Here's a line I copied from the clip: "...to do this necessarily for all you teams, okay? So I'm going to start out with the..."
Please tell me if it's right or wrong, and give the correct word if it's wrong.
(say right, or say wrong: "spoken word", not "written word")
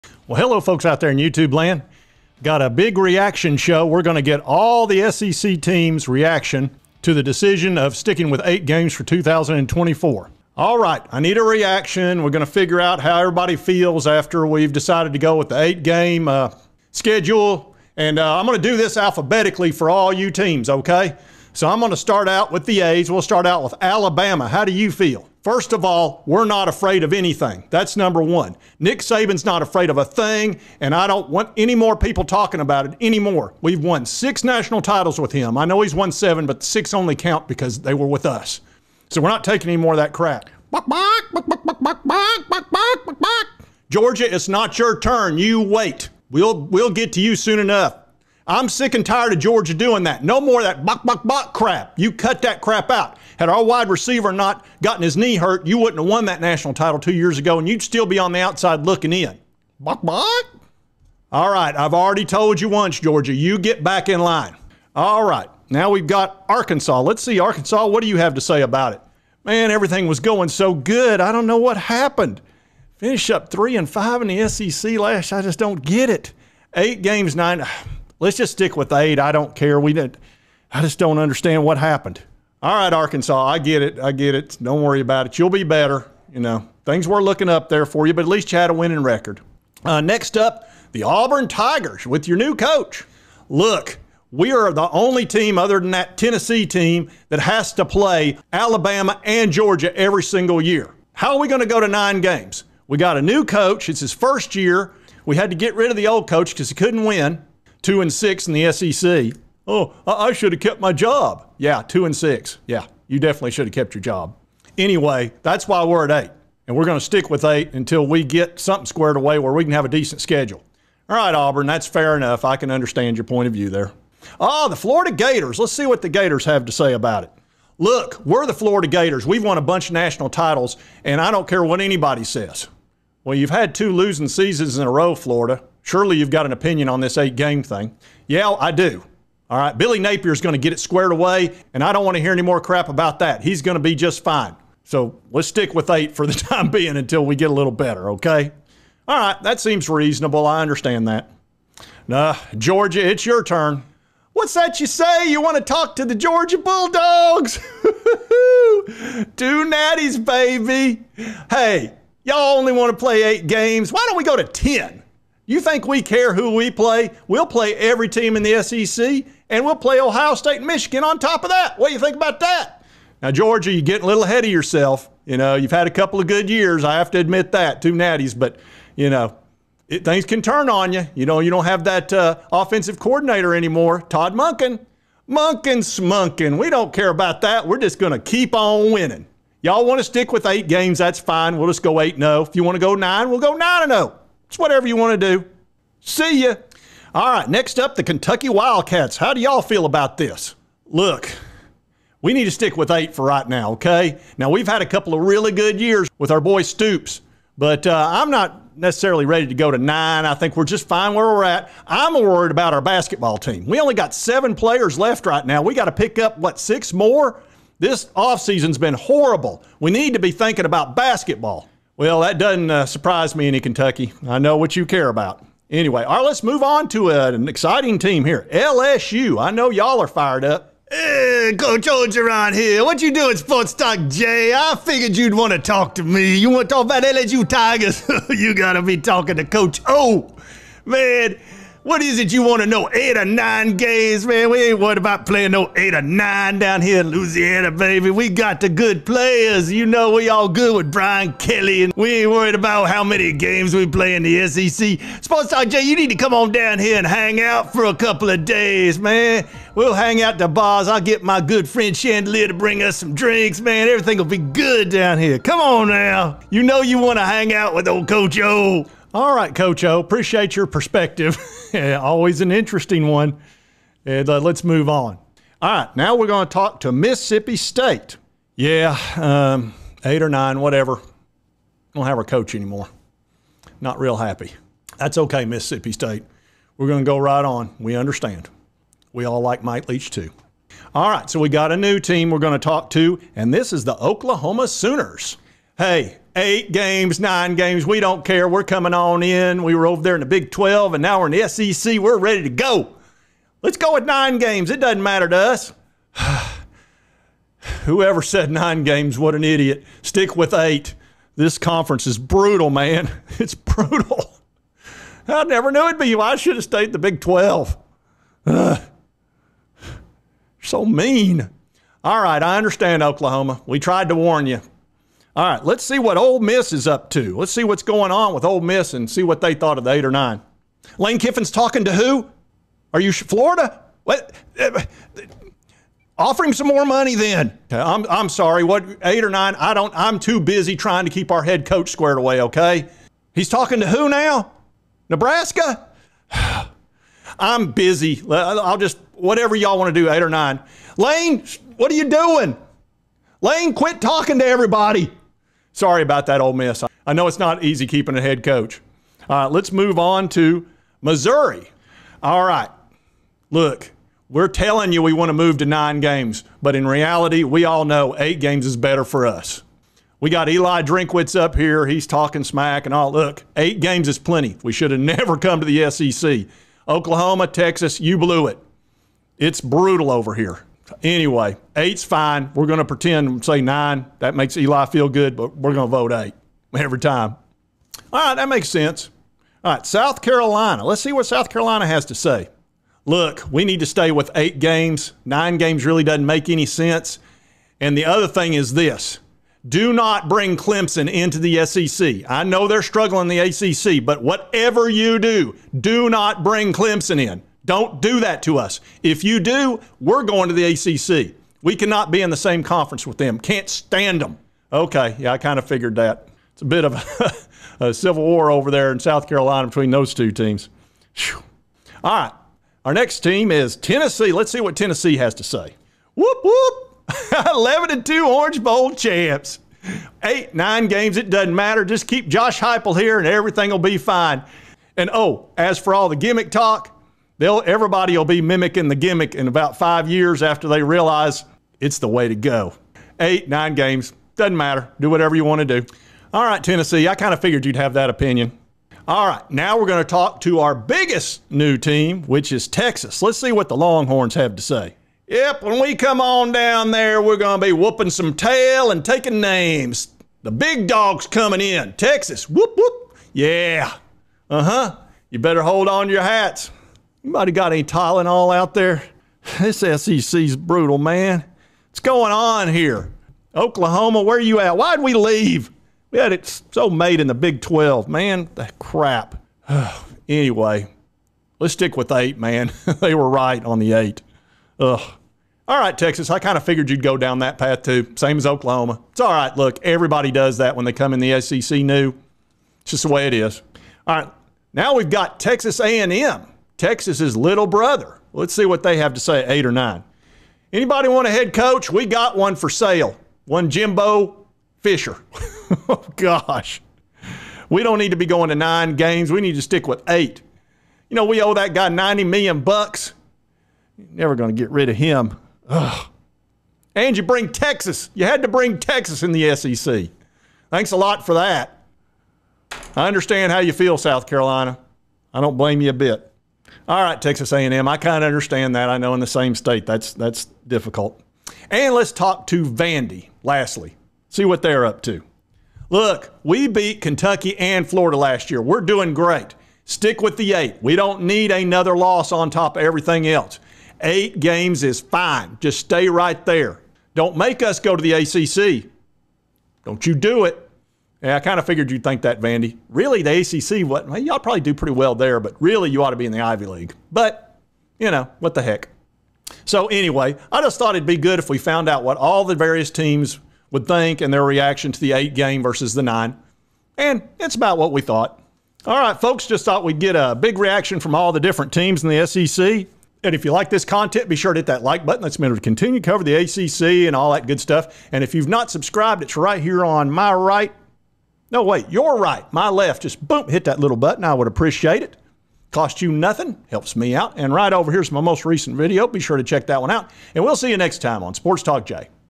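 wrong: "alphabetically", not "necessarily".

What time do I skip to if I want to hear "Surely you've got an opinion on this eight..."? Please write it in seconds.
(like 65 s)
135 s.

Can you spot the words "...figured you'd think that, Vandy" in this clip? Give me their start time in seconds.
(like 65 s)
551 s.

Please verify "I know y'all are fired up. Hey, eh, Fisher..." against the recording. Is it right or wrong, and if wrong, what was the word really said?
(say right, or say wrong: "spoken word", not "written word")
wrong: "Coach", not "Fisher".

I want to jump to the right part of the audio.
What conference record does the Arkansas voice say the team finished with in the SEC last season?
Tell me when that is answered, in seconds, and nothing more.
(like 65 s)
73 s.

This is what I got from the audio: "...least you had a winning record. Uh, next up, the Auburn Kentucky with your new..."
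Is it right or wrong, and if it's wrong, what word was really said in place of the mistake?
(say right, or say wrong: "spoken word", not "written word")
wrong: "Tigers", not "Kentucky".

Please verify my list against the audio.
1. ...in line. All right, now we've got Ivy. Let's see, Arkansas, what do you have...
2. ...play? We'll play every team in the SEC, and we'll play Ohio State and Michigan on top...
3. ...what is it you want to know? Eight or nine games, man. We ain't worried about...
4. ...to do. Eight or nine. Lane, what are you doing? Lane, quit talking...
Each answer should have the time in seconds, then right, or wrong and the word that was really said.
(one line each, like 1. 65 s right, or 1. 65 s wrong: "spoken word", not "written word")
1. 64 s wrong: "Arkansas", not "Ivy"
2. 166 s right
3. 241 s right
4. 349 s right.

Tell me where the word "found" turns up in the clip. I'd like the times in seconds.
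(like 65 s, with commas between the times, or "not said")
561 s.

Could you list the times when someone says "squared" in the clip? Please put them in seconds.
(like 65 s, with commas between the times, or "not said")
118 s, 140 s, 341 s.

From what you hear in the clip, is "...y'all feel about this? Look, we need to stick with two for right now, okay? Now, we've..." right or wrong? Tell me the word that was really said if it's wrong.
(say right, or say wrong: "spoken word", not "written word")
wrong: "eight", not "two".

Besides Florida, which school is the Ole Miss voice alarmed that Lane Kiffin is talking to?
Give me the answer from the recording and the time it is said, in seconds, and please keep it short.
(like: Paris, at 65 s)
Nebraska, at 345 s.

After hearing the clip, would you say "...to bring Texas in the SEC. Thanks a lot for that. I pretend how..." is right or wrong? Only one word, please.
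wrong.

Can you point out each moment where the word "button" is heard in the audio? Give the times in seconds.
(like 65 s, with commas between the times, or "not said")
575 s, 583 s.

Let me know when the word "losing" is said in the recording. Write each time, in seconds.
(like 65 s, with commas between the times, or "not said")
133 s.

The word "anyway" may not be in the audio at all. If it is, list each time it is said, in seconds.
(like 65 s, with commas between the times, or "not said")
114 s, 225 s, 381 s, 480 s, 559 s.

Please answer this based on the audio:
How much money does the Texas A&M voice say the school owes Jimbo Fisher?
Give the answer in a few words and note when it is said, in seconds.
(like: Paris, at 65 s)
$90 million, at 511 s.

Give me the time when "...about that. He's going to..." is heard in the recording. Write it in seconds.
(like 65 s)
142 s.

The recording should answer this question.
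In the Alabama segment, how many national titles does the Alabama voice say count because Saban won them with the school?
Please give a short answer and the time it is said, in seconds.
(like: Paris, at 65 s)
6, at 34 s.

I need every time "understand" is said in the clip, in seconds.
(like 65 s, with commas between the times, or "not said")
81 s, 122 s, 150 s, 287 s, 322 s, 523 s, 528 s.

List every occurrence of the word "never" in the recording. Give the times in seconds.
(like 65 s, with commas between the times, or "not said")
315 s, 374 s, 514 s.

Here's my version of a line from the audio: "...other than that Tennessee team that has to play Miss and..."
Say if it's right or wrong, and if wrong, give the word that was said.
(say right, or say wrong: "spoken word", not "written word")
wrong: "Alabama", not "Miss".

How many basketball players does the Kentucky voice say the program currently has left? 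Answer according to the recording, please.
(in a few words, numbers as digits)
7.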